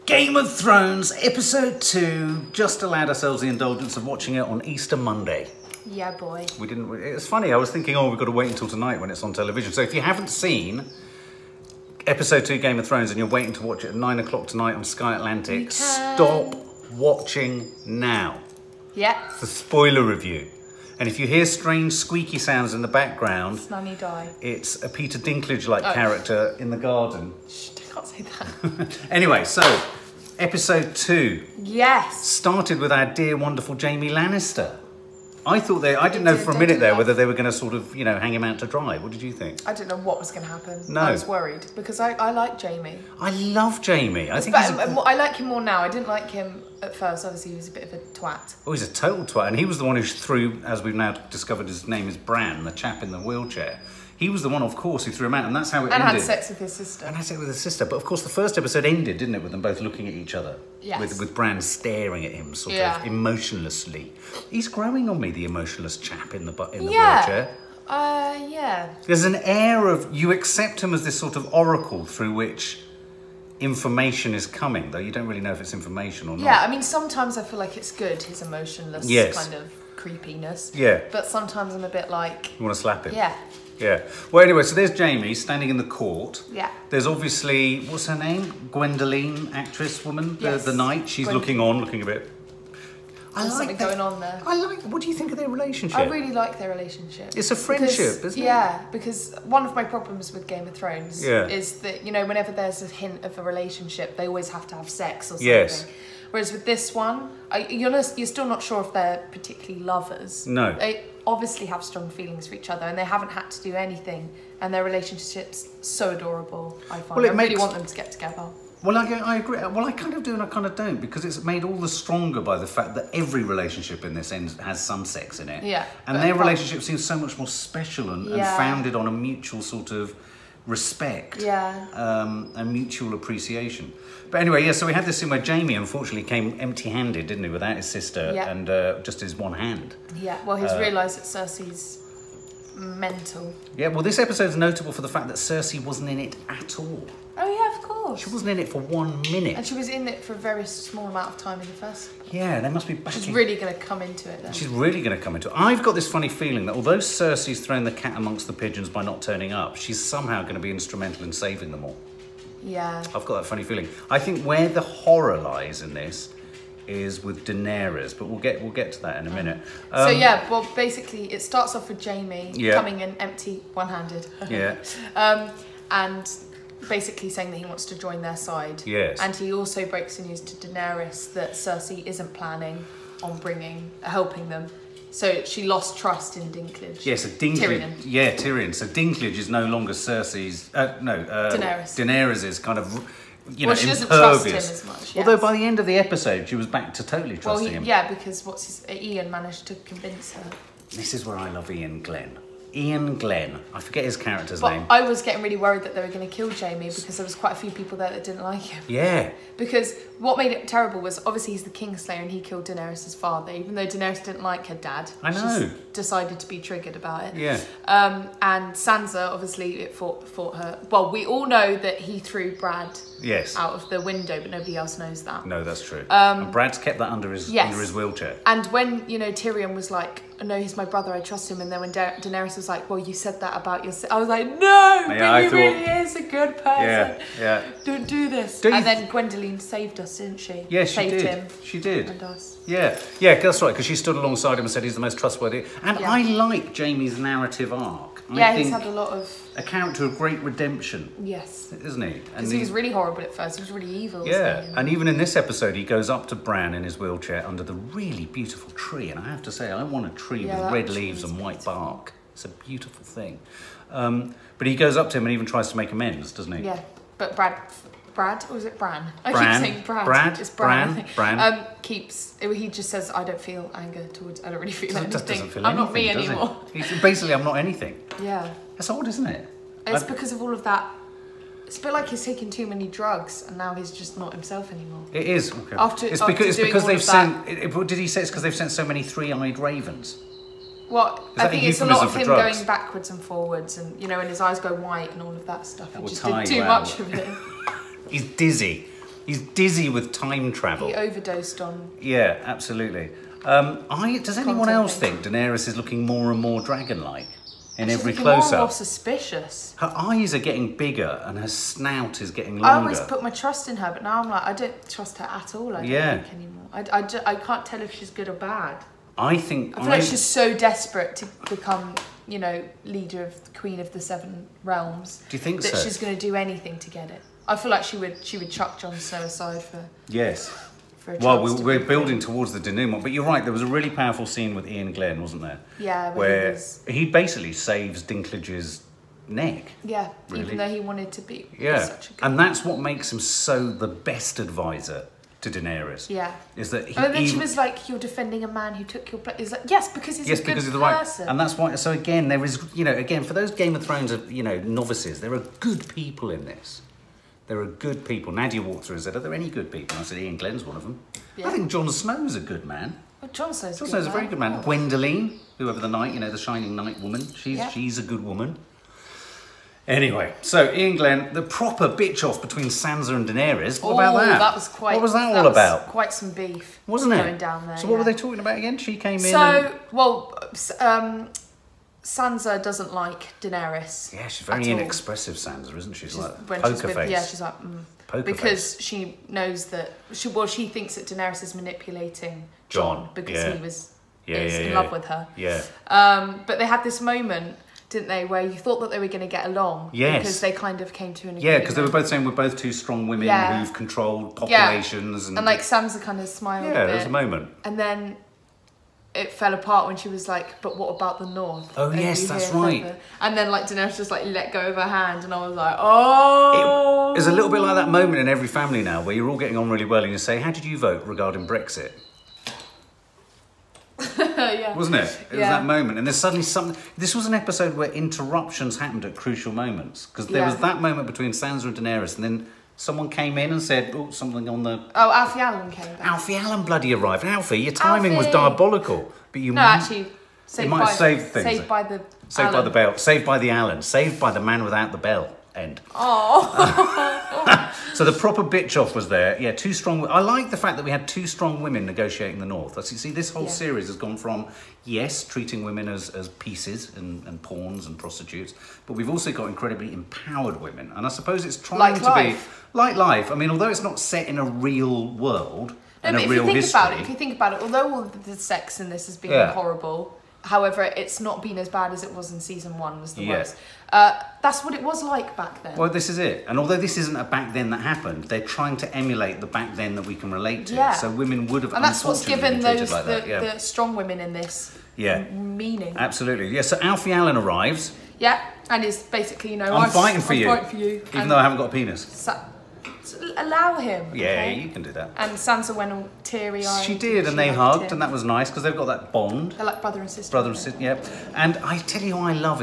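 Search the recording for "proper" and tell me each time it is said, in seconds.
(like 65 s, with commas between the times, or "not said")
371 s, 448 s.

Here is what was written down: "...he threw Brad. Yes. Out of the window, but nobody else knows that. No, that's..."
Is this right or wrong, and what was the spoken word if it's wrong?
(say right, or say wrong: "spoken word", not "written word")
right.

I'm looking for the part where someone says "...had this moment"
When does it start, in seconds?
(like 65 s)
396 s.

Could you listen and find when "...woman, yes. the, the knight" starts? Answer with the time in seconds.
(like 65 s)
90 s.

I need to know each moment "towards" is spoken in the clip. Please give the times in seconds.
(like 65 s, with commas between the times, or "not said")
274 s, 332 s.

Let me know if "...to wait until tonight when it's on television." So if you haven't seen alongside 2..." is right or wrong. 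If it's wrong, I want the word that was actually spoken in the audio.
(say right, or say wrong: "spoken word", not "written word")
wrong: "episode", not "alongside".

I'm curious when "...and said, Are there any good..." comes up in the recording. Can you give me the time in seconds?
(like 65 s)
358 s.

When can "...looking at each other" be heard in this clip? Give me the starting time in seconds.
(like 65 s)
59 s.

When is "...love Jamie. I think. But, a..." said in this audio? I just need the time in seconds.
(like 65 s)
43 s.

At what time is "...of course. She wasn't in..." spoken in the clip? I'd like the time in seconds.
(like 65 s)
147 s.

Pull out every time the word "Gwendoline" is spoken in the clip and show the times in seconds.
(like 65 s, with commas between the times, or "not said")
88 s, 239 s, 364 s.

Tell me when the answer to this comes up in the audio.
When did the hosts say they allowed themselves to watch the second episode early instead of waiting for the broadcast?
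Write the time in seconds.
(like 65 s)
4 s.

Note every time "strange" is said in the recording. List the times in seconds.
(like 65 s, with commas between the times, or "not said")
21 s.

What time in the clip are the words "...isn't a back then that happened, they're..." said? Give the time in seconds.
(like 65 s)
476 s.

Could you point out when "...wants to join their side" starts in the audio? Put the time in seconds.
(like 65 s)
177 s.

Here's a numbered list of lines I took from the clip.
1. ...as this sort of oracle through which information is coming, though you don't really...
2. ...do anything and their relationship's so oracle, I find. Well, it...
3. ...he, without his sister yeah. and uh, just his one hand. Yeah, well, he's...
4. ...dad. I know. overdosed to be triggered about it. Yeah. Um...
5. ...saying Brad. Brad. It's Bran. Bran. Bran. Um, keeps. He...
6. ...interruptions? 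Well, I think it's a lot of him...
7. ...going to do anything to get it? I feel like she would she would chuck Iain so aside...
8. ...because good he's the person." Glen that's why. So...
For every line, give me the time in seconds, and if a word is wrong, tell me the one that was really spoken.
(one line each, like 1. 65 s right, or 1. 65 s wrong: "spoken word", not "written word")
1. 70 s right
2. 113 s wrong: "adorable", not "oracle"
3. 137 s right
4. 214 s wrong: "decided", not "overdosed"
5. 269 s right
6. 289 s wrong: "ravens", not "interruptions"
7. 325 s wrong: "Jon", not "Iain"
8. 350 s wrong: "And", not "Glen".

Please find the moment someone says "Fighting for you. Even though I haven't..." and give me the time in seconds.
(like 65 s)
490 s.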